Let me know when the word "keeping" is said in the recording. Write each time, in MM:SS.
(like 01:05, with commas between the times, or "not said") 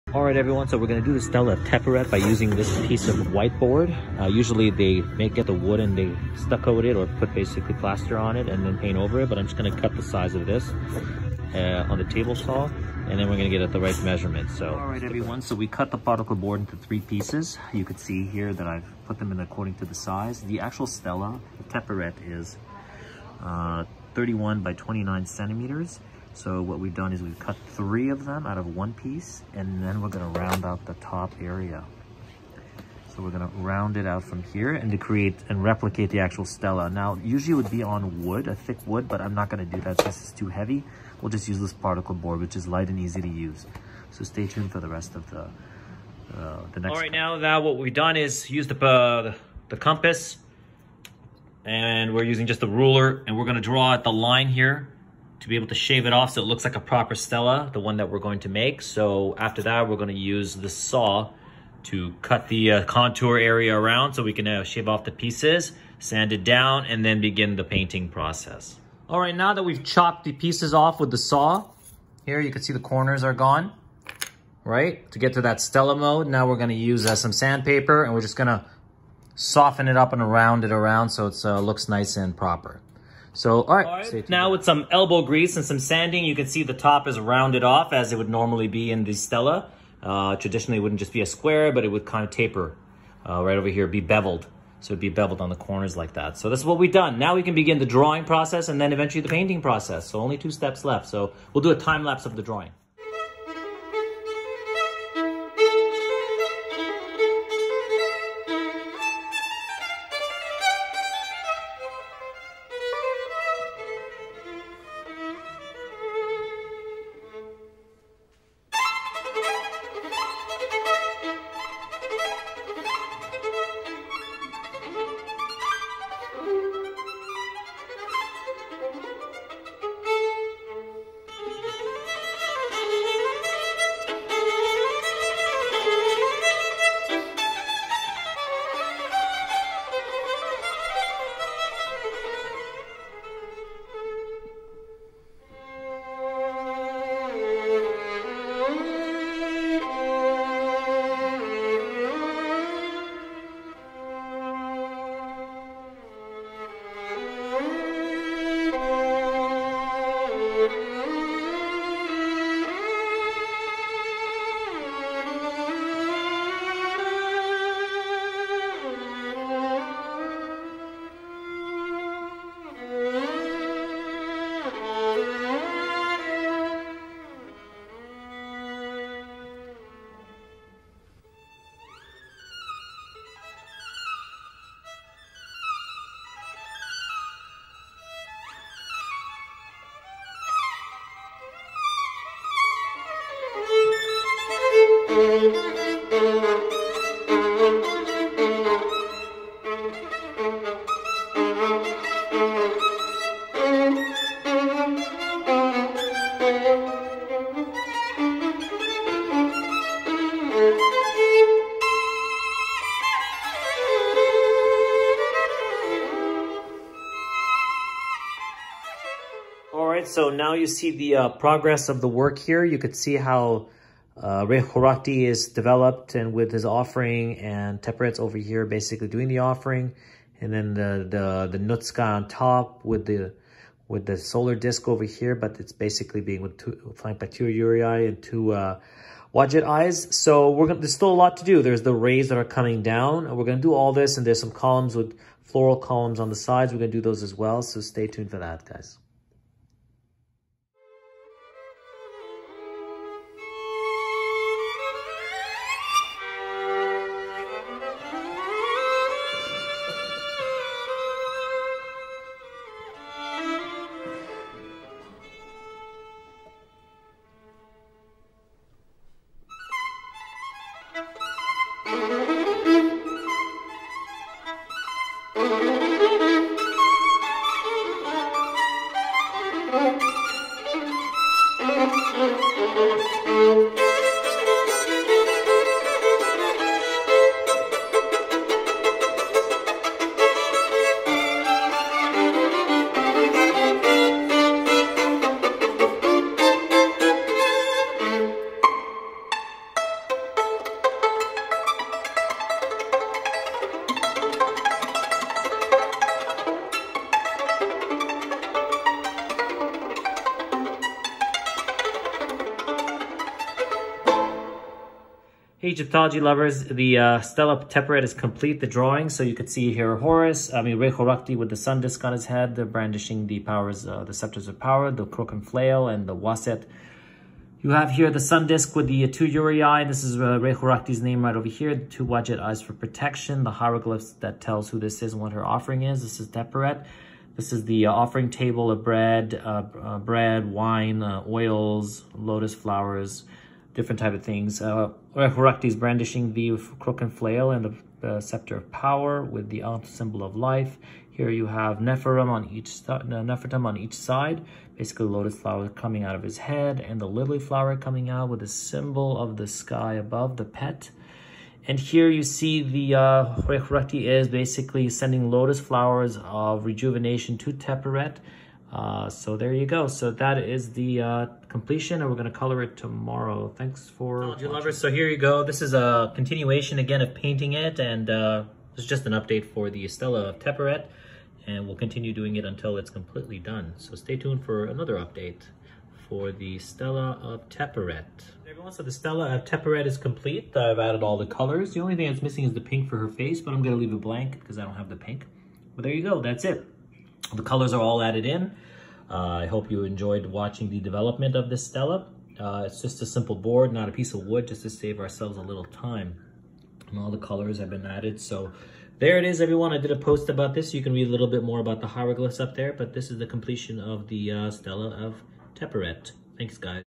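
not said.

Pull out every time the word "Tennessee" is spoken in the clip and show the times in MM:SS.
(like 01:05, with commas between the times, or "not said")
not said.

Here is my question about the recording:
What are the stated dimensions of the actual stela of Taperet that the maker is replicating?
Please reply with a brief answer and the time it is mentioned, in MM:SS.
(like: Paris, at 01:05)
31 by 29 centimeters, at 00:24.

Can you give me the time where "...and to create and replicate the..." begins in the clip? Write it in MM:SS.
00:34.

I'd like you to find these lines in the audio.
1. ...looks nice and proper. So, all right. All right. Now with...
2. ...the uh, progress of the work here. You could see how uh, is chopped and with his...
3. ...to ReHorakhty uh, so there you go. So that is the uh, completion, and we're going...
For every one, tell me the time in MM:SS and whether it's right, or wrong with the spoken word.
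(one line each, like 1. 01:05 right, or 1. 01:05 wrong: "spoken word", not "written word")
1. 01:21 right
2. 03:40 wrong: "developed", not "chopped"
3. 06:07 wrong: "Taperet", not "ReHorakhty".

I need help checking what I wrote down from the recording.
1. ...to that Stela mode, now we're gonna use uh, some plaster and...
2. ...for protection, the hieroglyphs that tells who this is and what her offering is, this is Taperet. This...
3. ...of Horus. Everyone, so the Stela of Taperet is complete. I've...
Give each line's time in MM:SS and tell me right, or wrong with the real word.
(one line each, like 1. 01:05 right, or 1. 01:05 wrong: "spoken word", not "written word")
1. 01:15 wrong: "sandpaper", not "plaster"
2. 05:32 right
3. 06:27 wrong: "Taperet", not "Horus".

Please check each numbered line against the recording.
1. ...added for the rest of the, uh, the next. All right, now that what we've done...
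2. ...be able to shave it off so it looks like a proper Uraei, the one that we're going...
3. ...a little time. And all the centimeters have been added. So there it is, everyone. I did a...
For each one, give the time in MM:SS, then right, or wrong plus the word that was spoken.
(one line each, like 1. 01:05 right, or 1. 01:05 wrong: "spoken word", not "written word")
1. 00:44 wrong: "tuned", not "added"
2. 00:55 wrong: "Stela", not "Uraei"
3. 06:45 wrong: "colors", not "centimeters".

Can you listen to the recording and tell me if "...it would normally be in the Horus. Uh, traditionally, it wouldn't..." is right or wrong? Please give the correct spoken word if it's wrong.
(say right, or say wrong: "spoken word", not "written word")
wrong: "Stela", not "Horus".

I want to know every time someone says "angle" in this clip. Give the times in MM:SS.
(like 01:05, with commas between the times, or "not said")
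not said.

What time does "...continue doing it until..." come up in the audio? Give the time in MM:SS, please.
06:21.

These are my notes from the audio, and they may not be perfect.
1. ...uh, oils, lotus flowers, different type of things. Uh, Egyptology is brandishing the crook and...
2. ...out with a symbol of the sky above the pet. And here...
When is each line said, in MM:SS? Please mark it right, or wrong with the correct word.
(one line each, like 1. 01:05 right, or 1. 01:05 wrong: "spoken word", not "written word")
1. 05:41 wrong: "Horakhty", not "Egyptology"
2. 05:58 right.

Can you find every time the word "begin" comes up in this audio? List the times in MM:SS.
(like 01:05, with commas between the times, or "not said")
01:07, 01:37.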